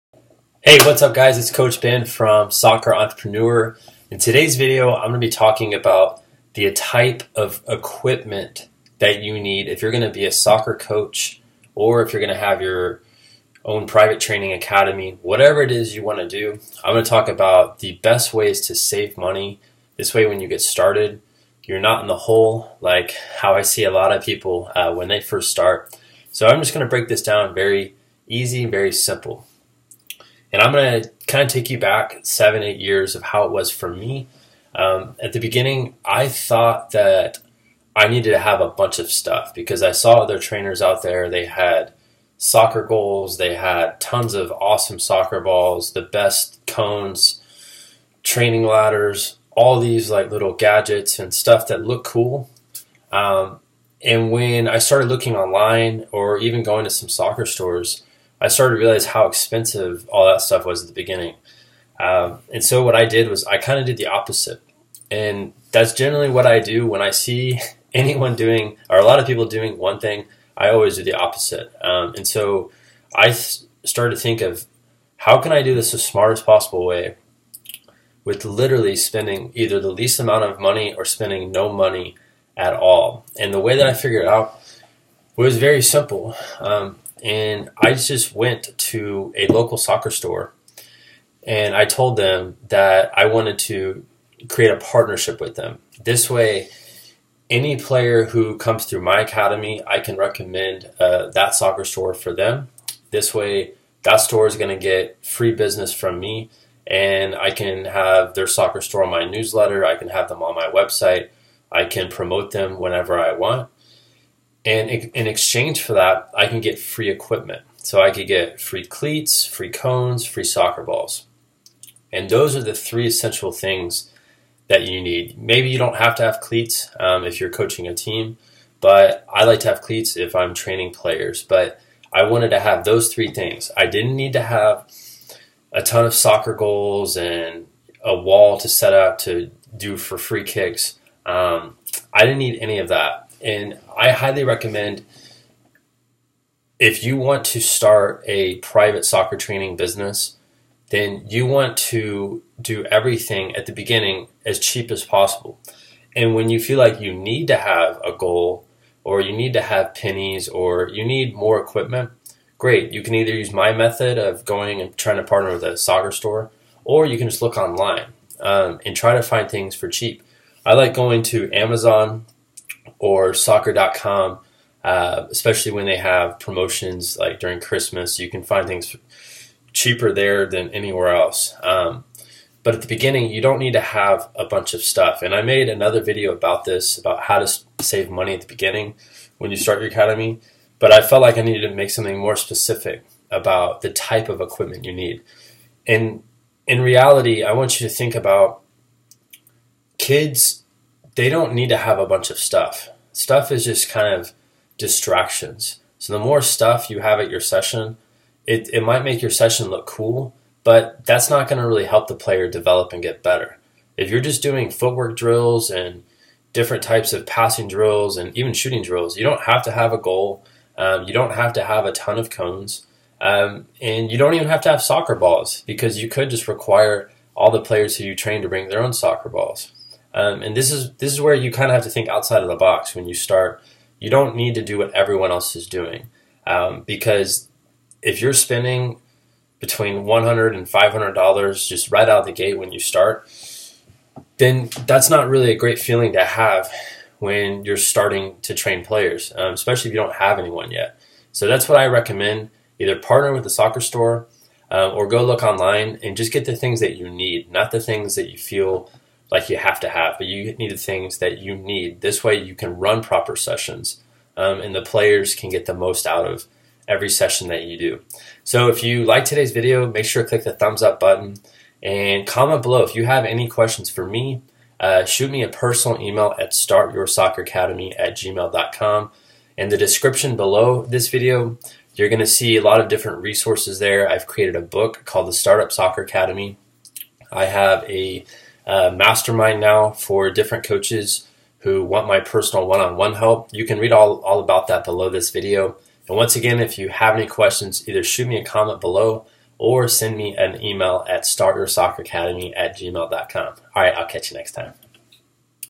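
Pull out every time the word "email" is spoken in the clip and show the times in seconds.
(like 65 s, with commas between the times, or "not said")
276 s, 300 s.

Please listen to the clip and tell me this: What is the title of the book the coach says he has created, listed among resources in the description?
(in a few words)
The Startup Soccer Academy.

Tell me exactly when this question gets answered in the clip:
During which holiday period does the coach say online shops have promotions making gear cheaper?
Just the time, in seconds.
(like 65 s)
177 s.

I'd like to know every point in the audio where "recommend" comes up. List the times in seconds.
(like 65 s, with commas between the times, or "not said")
100 s, 144 s, 251 s.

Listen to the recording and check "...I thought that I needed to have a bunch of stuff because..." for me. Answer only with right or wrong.
right.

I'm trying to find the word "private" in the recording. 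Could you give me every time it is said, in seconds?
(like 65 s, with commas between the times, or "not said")
13 s, 148 s.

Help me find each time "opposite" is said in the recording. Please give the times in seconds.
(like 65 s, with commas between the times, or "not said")
64 s, 71 s.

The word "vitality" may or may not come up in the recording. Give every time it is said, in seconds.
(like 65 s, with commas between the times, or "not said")
not said.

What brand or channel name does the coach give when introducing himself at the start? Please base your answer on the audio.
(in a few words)
Soccer Entrepreneur.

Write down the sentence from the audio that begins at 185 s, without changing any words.
And I made another video about this, about how to save money at the beginning when you start your academy.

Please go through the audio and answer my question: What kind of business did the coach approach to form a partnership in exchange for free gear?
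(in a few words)
local soccer store.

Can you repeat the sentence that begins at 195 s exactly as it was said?
And in reality, I want you to think about kids they don't need to have a bunch of stuff.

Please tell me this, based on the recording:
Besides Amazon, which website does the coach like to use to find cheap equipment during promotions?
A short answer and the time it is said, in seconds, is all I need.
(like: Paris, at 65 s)
soccer.com, at 173 s.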